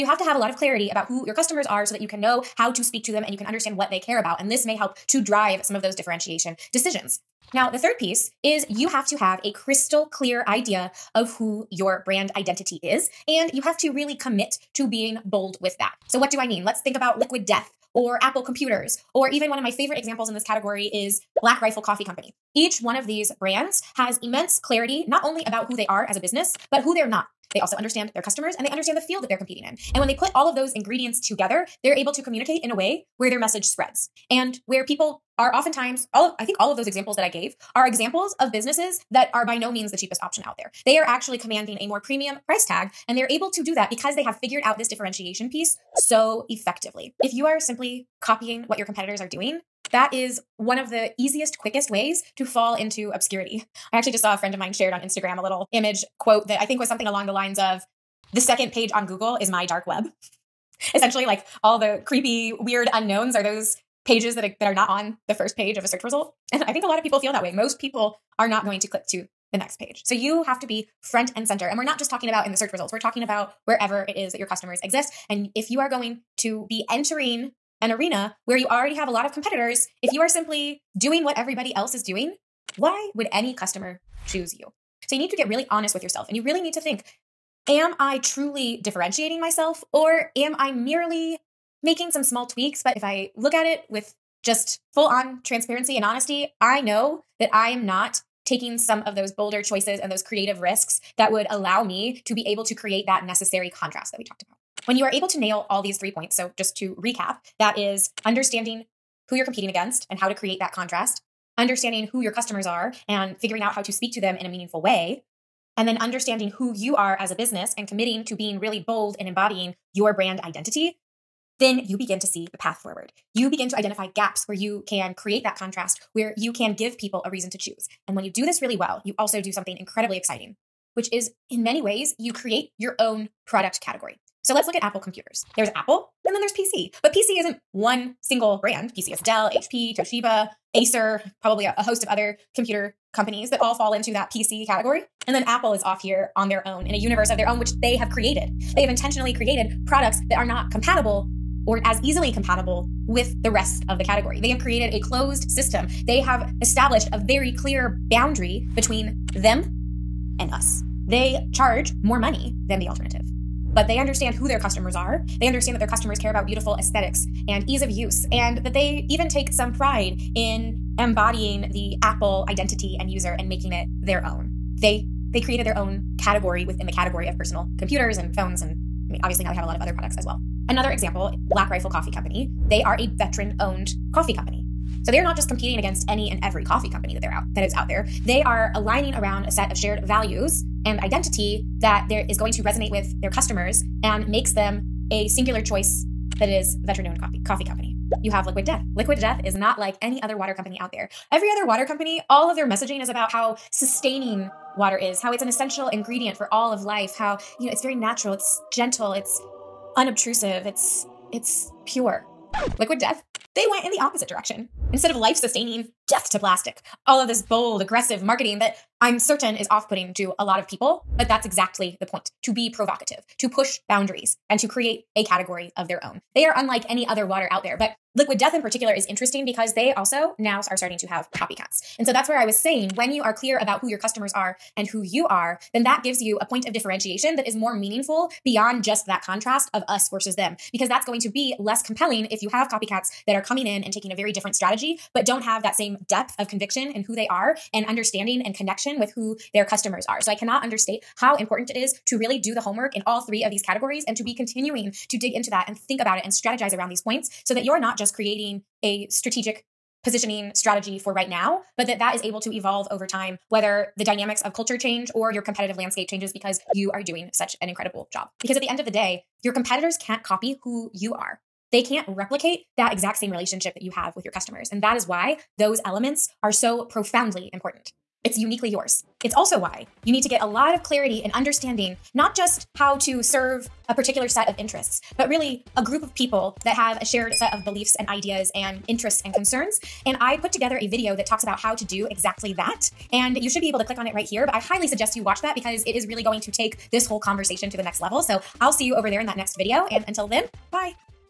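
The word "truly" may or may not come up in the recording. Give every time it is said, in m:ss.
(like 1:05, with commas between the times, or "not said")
1:28.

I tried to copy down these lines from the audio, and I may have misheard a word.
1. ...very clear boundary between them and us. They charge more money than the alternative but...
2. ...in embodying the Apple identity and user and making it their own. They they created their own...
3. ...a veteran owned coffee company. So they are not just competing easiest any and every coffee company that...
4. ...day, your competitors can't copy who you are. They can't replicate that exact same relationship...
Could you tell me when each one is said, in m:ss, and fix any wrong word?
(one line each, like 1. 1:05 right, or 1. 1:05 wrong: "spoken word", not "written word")
1. 2:37 right
2. 2:50 right
3. 3:02 wrong: "against", not "easiest"
4. 4:28 right.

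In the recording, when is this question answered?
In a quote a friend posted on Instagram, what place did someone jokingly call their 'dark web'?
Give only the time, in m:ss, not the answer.
0:58.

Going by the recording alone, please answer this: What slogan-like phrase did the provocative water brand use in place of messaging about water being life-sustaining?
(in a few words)
Death to plastic.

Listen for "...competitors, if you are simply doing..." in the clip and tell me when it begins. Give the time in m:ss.
1:19.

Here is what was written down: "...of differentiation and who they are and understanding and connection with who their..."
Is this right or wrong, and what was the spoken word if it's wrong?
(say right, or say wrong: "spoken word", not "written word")
wrong: "conviction", not "differentiation".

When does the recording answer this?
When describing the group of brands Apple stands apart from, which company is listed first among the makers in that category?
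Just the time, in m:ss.
2:19.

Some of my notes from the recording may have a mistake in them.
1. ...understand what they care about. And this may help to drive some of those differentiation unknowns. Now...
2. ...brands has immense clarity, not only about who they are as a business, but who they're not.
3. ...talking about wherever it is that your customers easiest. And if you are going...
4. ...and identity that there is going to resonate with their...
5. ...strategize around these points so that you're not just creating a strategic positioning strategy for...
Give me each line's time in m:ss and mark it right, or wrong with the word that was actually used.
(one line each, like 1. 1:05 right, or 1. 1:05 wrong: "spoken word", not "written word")
1. 0:03 wrong: "decisions", not "unknowns"
2. 0:23 right
3. 1:12 wrong: "exist", not "easiest"
4. 3:10 right
5. 4:16 right.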